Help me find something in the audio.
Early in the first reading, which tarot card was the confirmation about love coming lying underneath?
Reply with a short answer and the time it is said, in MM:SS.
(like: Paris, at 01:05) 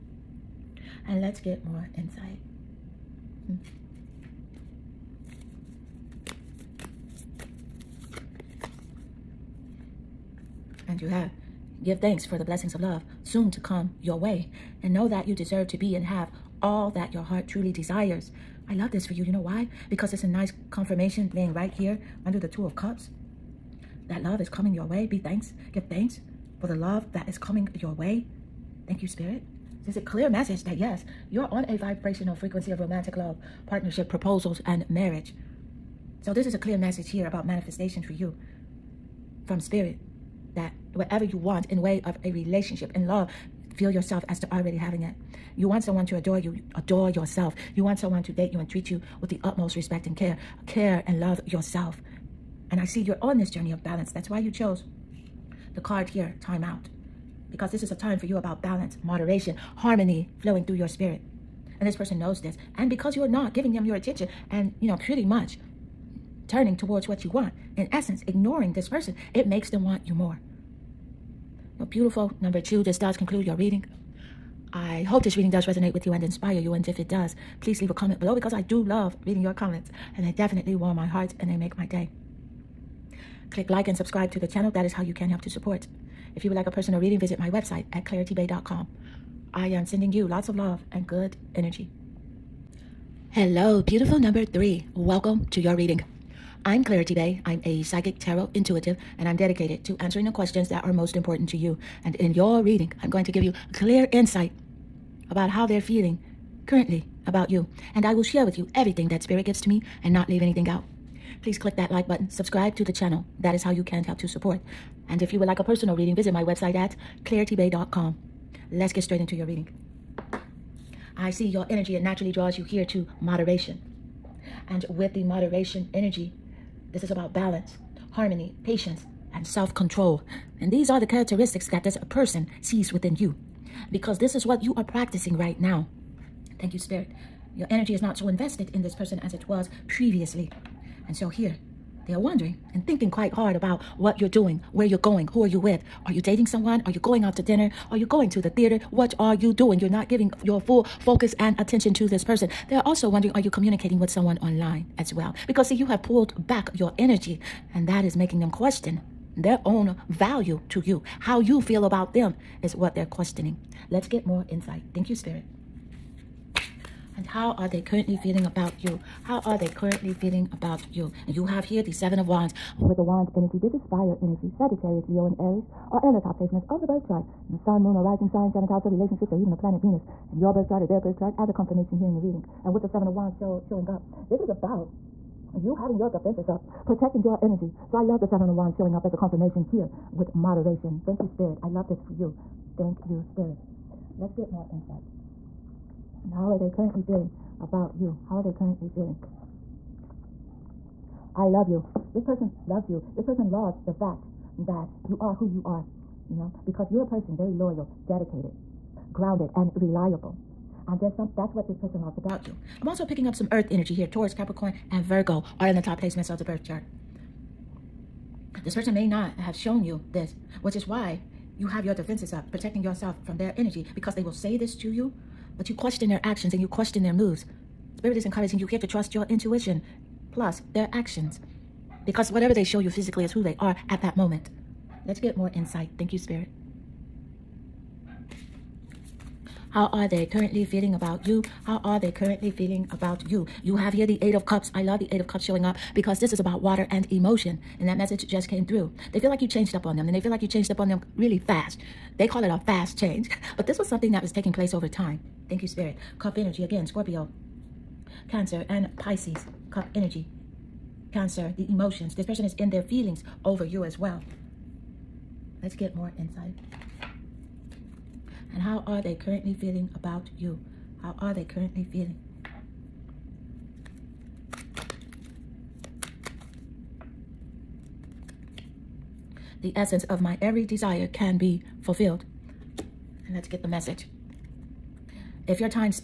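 Two of Cups, at 00:22.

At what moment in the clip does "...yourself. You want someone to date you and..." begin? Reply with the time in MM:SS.
00:47.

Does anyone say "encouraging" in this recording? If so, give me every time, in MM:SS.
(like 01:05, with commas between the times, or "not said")
03:48.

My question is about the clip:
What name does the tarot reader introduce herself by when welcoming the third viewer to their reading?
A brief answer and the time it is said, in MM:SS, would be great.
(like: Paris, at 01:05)
Clarity Bae, at 01:36.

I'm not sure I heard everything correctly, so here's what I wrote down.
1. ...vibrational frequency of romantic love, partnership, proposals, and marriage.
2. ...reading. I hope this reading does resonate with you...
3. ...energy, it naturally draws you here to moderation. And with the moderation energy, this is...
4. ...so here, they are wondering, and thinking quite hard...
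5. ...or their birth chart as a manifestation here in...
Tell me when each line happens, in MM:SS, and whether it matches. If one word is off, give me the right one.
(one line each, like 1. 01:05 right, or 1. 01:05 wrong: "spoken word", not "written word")
1. 00:31 right
2. 01:13 right
3. 02:01 right
4. 02:21 right
5. 03:00 wrong: "confirmation", not "manifestation".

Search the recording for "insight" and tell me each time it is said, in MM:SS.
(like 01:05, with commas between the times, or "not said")
00:01, 01:44, 02:44, 03:14, 03:55, 04:26.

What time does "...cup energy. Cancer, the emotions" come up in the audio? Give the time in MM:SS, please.
04:19.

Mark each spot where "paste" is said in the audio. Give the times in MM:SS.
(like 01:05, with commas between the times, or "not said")
not said.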